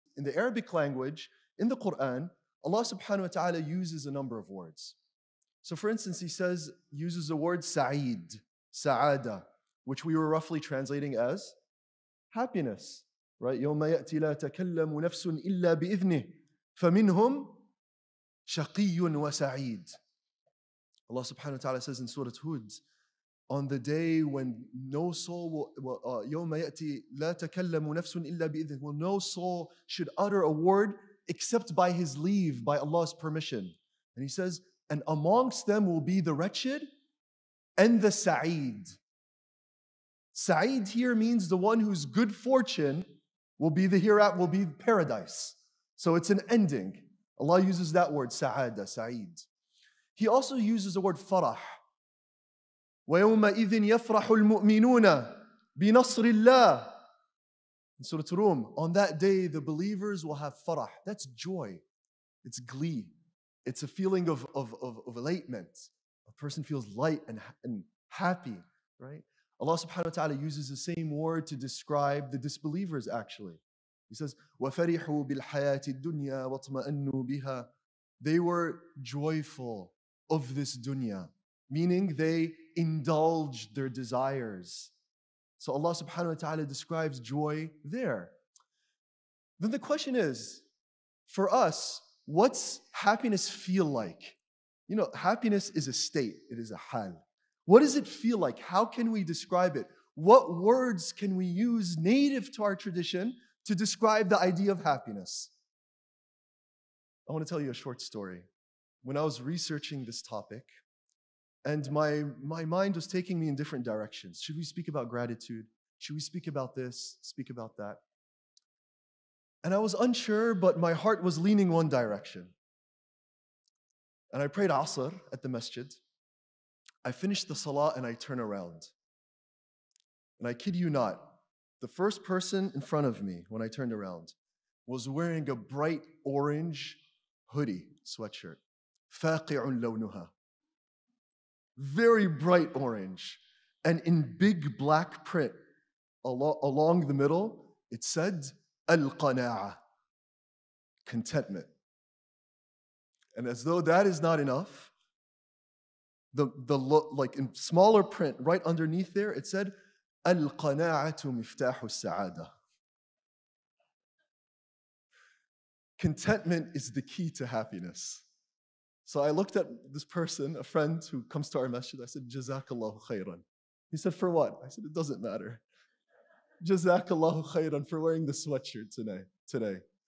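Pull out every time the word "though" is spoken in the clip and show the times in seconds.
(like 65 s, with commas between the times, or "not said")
153 s.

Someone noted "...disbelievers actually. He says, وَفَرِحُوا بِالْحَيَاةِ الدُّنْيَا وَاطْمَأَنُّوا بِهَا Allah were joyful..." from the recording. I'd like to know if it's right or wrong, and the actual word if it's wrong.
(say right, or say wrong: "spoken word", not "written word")
wrong: "They", not "Allah".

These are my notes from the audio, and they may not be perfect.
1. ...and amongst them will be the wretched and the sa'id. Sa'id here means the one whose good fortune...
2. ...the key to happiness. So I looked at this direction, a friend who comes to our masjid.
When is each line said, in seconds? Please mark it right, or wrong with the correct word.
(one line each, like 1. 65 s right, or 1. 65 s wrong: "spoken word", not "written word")
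1. 34 s right
2. 166 s wrong: "person", not "direction".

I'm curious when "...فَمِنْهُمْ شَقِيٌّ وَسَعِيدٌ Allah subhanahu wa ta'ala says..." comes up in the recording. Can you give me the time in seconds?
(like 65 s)
16 s.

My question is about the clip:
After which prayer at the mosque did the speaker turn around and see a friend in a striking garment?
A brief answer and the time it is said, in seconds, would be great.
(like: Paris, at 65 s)
Asr, at 124 s.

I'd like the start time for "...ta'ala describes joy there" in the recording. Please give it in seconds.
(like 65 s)
86 s.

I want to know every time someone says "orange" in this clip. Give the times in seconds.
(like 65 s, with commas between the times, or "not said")
136 s, 142 s.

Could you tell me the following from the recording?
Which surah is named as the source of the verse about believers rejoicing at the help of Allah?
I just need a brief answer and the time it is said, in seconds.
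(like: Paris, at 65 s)
Surah Rum, at 58 s.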